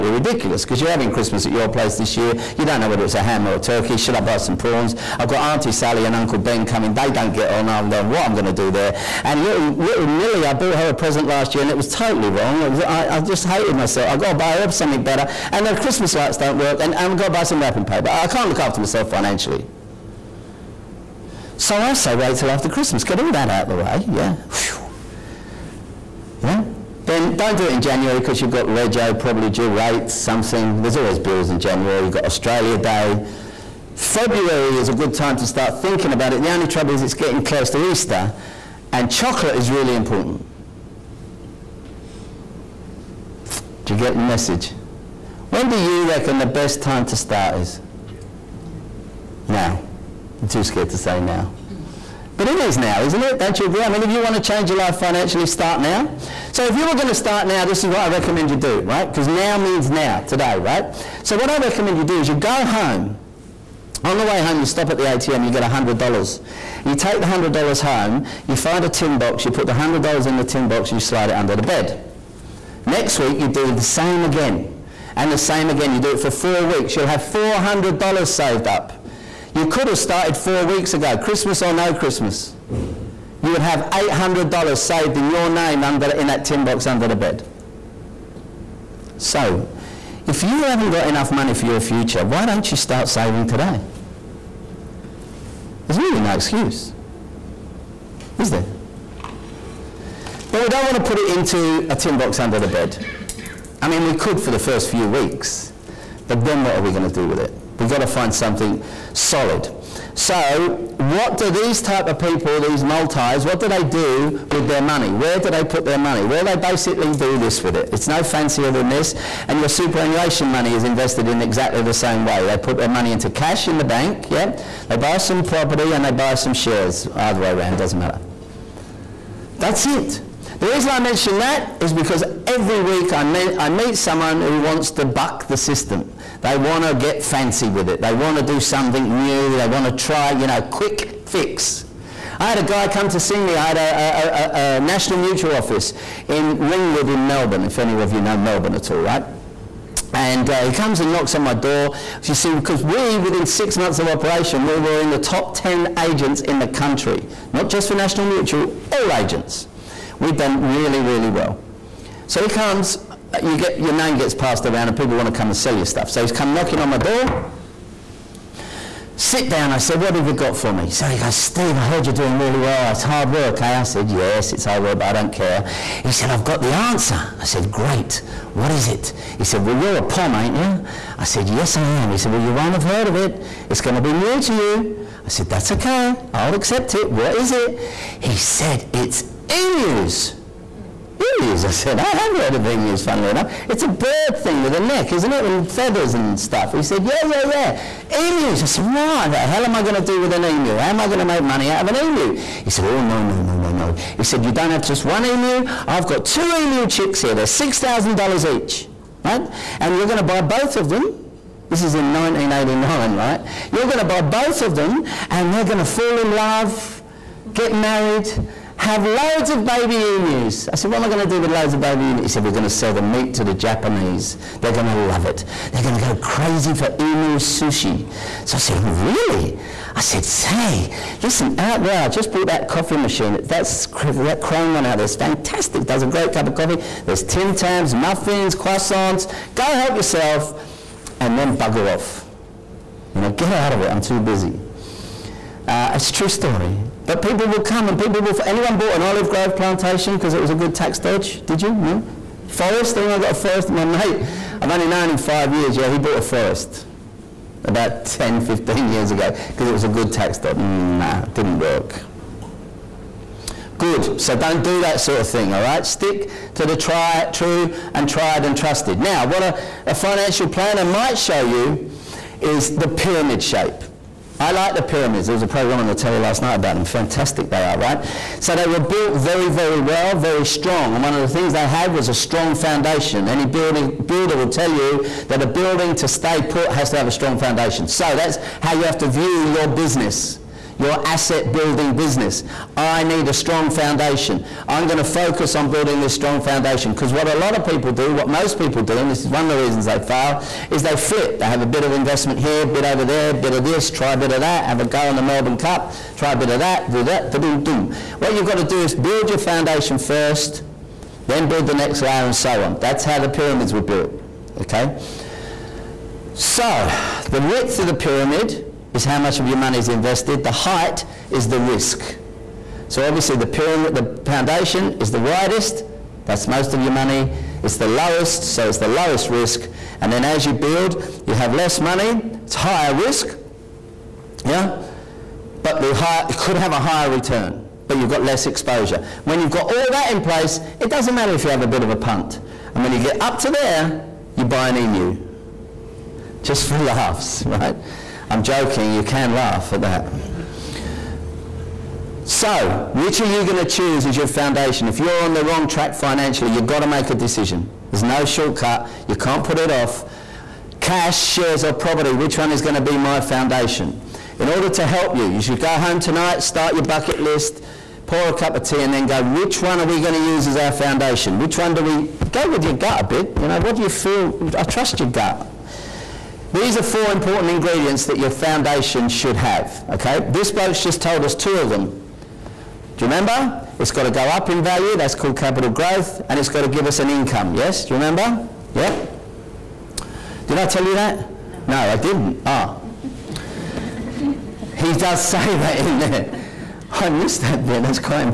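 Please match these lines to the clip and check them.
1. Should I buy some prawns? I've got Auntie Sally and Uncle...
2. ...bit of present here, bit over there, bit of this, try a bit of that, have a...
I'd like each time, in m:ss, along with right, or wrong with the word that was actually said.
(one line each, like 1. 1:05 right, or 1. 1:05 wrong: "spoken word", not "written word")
1. 0:03 right
2. 5:01 wrong: "investment", not "present".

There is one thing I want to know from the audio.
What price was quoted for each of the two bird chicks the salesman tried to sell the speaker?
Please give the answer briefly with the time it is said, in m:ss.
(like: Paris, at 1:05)
$6,000, at 3:27.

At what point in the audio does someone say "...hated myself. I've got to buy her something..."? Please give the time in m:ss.
0:13.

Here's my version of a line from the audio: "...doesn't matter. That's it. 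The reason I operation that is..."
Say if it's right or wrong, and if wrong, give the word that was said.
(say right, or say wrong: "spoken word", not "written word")
wrong: "mention", not "operation".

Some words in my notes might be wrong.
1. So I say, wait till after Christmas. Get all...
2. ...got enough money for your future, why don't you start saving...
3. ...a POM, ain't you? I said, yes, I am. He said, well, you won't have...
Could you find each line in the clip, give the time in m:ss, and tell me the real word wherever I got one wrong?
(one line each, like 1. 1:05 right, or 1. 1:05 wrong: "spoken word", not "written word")
1. 0:21 right
2. 1:30 right
3. 2:59 right.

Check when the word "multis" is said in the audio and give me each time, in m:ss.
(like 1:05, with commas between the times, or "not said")
1:52.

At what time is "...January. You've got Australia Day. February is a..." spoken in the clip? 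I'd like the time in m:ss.
0:31.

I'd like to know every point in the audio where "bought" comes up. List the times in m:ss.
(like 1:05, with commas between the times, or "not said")
0:10, 3:52, 4:08, 4:15.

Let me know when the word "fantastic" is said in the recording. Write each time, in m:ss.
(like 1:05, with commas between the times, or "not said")
3:55, 4:36.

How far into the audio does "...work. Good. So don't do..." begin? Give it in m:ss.
4:21.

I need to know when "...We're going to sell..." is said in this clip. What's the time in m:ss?
3:42.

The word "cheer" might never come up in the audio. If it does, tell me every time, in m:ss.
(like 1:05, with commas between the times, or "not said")
not said.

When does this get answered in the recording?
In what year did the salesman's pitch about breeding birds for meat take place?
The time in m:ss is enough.
3:32.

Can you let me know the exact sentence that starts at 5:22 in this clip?
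So obviously the pyramid, the foundation is the widest.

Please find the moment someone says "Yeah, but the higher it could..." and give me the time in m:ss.
5:34.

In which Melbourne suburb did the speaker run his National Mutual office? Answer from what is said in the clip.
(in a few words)
Ringwood.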